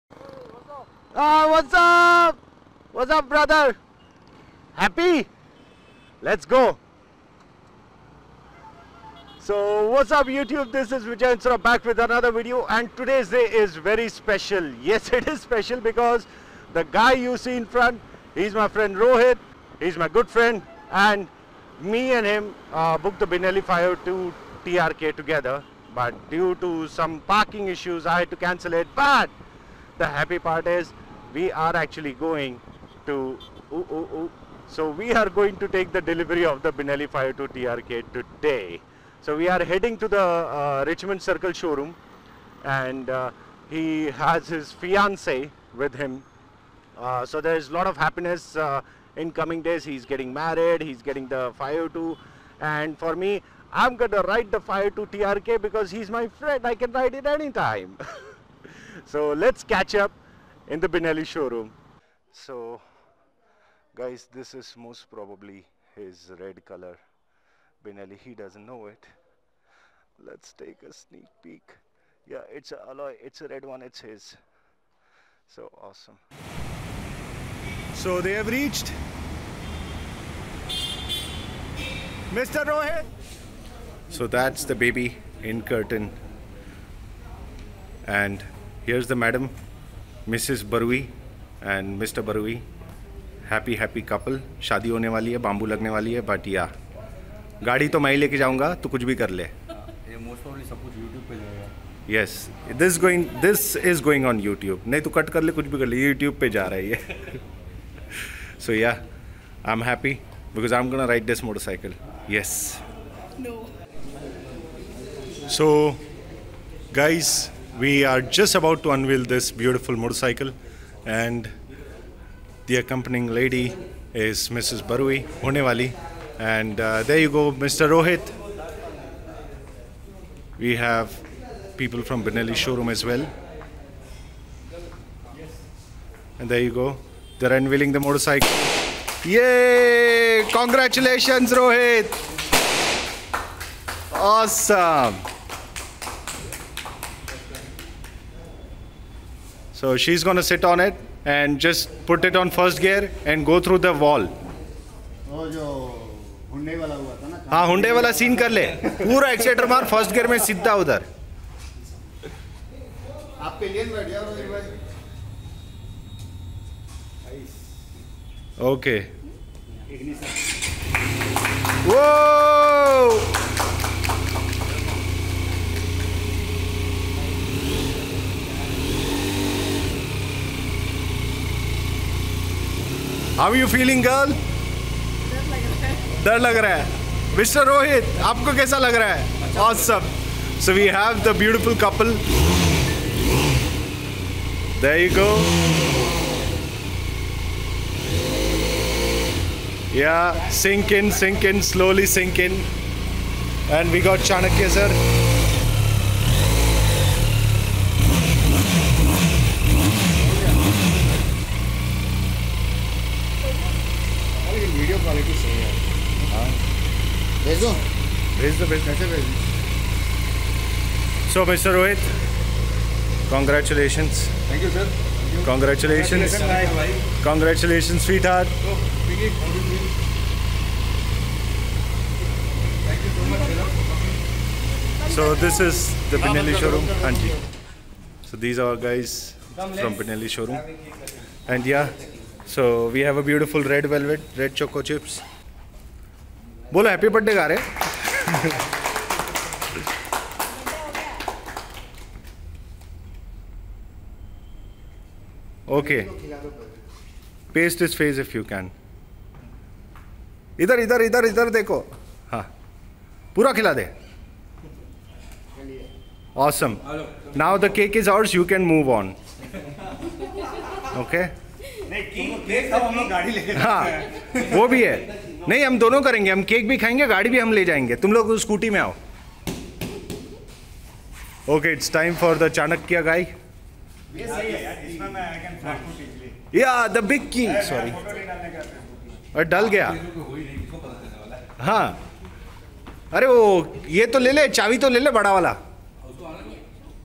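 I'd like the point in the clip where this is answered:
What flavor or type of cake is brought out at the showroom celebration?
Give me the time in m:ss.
4:03.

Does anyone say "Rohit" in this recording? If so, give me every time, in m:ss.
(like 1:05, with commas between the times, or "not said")
0:18, 1:22, 2:07, 2:21.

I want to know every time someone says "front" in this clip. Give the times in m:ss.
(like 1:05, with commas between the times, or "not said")
0:17.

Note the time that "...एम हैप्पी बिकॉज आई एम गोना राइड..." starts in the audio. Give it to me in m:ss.
1:49.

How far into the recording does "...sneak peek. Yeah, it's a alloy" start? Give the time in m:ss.
1:10.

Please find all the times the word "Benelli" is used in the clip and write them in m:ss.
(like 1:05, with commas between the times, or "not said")
0:23, 0:36, 1:00, 1:07, 2:12.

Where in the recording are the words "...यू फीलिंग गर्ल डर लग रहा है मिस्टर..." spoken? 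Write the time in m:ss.
3:03.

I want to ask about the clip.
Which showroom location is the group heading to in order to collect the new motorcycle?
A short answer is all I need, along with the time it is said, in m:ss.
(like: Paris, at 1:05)
Richmond Circle, at 0:40.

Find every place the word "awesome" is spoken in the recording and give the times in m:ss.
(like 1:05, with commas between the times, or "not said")
1:15, 2:24, 4:26.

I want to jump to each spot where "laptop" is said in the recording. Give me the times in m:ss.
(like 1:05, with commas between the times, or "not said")
not said.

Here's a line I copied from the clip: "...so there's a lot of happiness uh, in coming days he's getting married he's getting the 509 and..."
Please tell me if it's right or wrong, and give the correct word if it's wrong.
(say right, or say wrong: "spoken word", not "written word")
wrong: "502", not "509".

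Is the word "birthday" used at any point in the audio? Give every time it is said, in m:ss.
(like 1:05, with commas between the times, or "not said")
4:07.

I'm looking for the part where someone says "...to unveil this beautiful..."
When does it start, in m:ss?
1:58.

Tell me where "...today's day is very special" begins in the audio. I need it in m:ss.
0:12.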